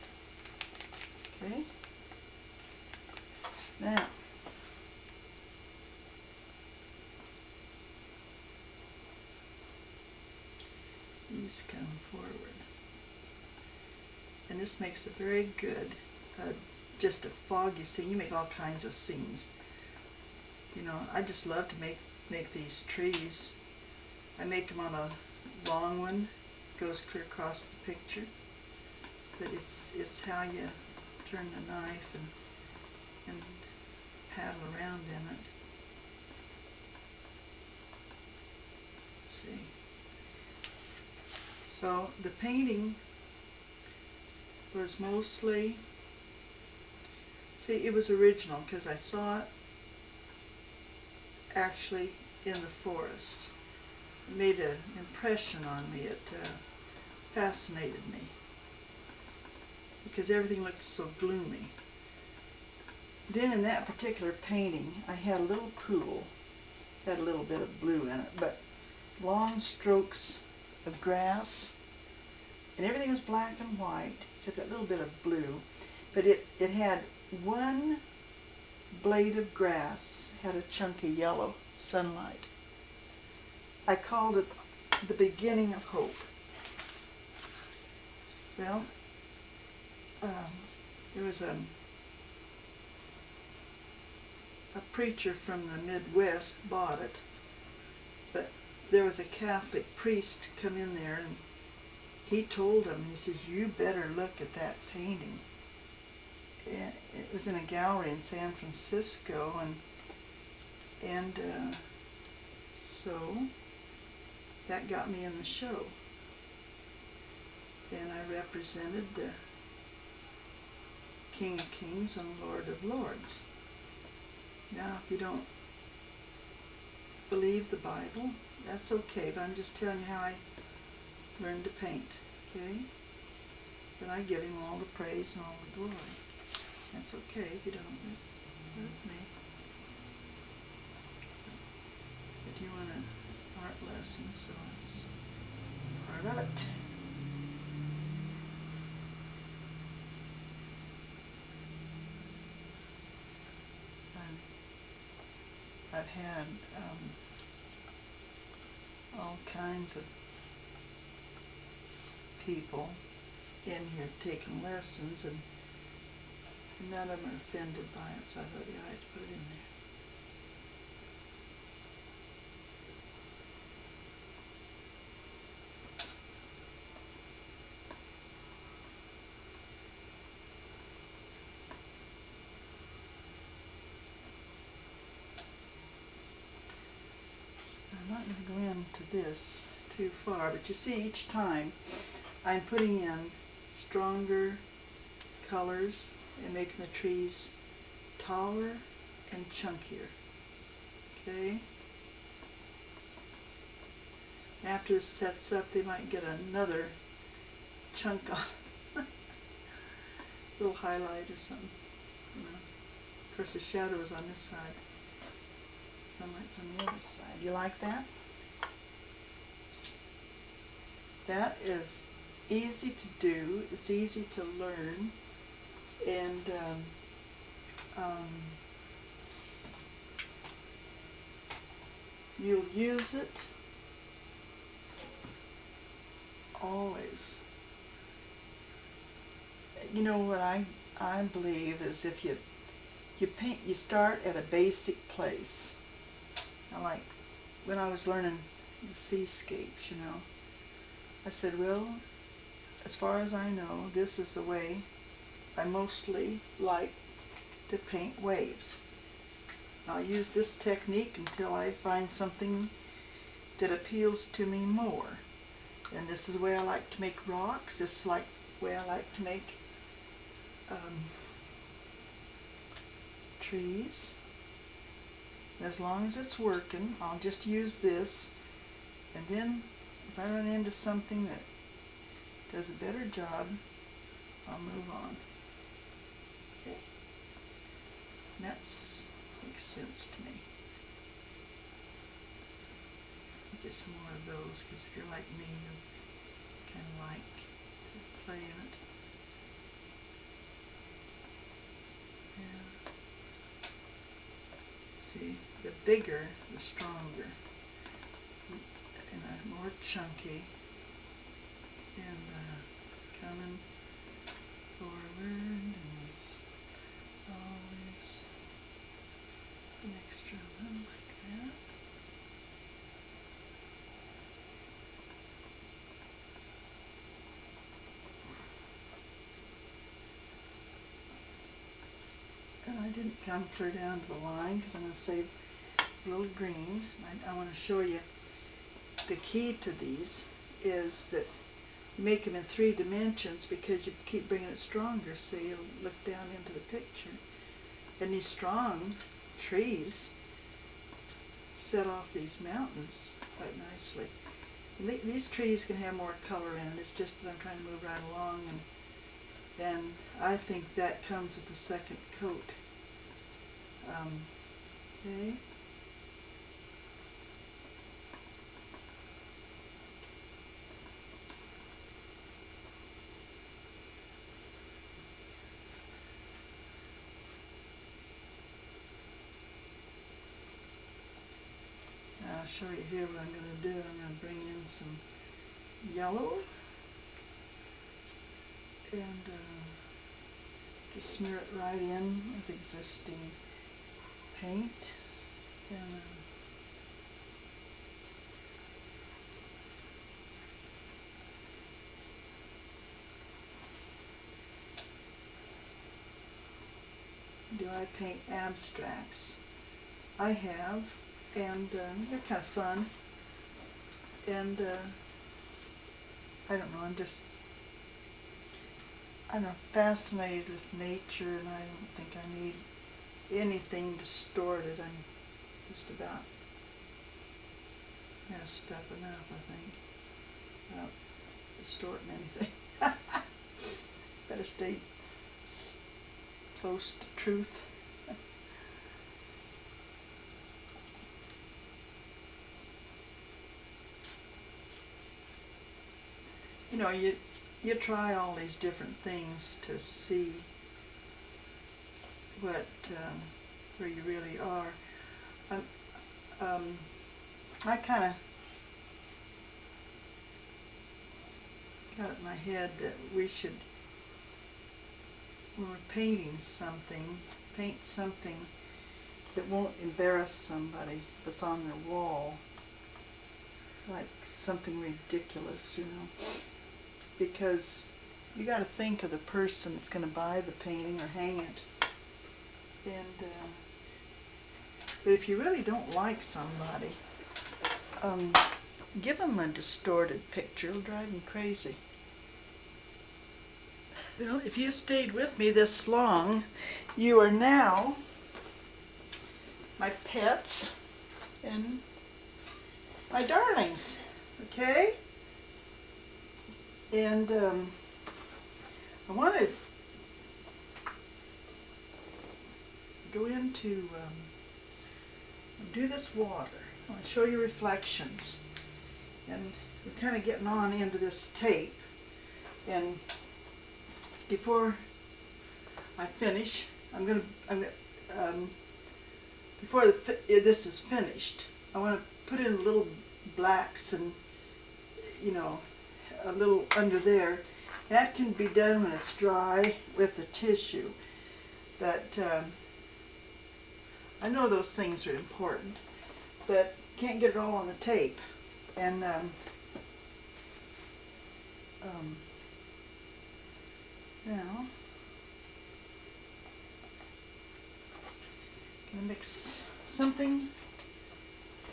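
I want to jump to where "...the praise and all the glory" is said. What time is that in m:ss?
2:14.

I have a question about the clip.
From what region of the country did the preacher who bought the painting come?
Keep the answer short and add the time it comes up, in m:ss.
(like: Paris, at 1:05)
the Midwest, at 1:35.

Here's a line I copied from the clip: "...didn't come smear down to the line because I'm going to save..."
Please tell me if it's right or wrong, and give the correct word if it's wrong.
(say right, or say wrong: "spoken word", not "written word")
wrong: "clear", not "smear".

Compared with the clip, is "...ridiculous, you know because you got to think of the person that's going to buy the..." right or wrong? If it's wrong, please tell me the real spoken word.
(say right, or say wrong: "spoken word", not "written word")
right.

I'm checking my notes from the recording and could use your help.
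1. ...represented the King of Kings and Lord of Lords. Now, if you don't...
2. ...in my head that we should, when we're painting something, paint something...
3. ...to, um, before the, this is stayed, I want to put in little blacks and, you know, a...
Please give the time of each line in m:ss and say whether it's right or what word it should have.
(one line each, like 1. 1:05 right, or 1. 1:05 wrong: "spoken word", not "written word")
1. 1:58 right
2. 7:42 right
3. 8:48 wrong: "finished", not "stayed".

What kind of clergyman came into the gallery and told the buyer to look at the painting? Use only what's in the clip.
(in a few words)
Catholic priest.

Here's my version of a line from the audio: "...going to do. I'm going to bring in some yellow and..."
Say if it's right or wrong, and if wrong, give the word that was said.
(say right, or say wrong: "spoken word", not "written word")
right.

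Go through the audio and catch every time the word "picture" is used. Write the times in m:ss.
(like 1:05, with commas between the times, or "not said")
0:27, 5:46, 8:10.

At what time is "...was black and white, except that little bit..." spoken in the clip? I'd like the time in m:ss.
1:13.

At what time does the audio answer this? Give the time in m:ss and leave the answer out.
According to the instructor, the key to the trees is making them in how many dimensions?
5:42.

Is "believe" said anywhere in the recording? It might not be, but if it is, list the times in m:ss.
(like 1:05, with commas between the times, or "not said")
2:07, 4:01.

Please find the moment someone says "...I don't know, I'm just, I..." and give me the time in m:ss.
6:56.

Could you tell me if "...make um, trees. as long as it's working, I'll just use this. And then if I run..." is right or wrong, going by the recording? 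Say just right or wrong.
right.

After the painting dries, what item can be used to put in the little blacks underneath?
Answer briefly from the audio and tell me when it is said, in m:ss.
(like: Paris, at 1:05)
a tissue, at 9:00.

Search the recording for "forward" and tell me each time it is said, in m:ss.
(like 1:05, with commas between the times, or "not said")
0:12, 5:14.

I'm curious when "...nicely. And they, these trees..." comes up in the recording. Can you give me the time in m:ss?
5:53.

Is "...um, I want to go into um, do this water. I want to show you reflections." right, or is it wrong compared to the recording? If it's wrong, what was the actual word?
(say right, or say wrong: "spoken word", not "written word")
right.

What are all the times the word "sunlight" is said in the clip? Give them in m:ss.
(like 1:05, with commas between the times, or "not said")
1:21, 3:36.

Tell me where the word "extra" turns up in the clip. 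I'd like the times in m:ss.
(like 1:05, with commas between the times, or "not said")
5:20.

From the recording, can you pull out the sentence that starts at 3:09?
this too far, but you see each time I'm putting in stronger colors and making the trees taller and chunkier.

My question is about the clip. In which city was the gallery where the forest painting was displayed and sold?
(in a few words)
San Francisco.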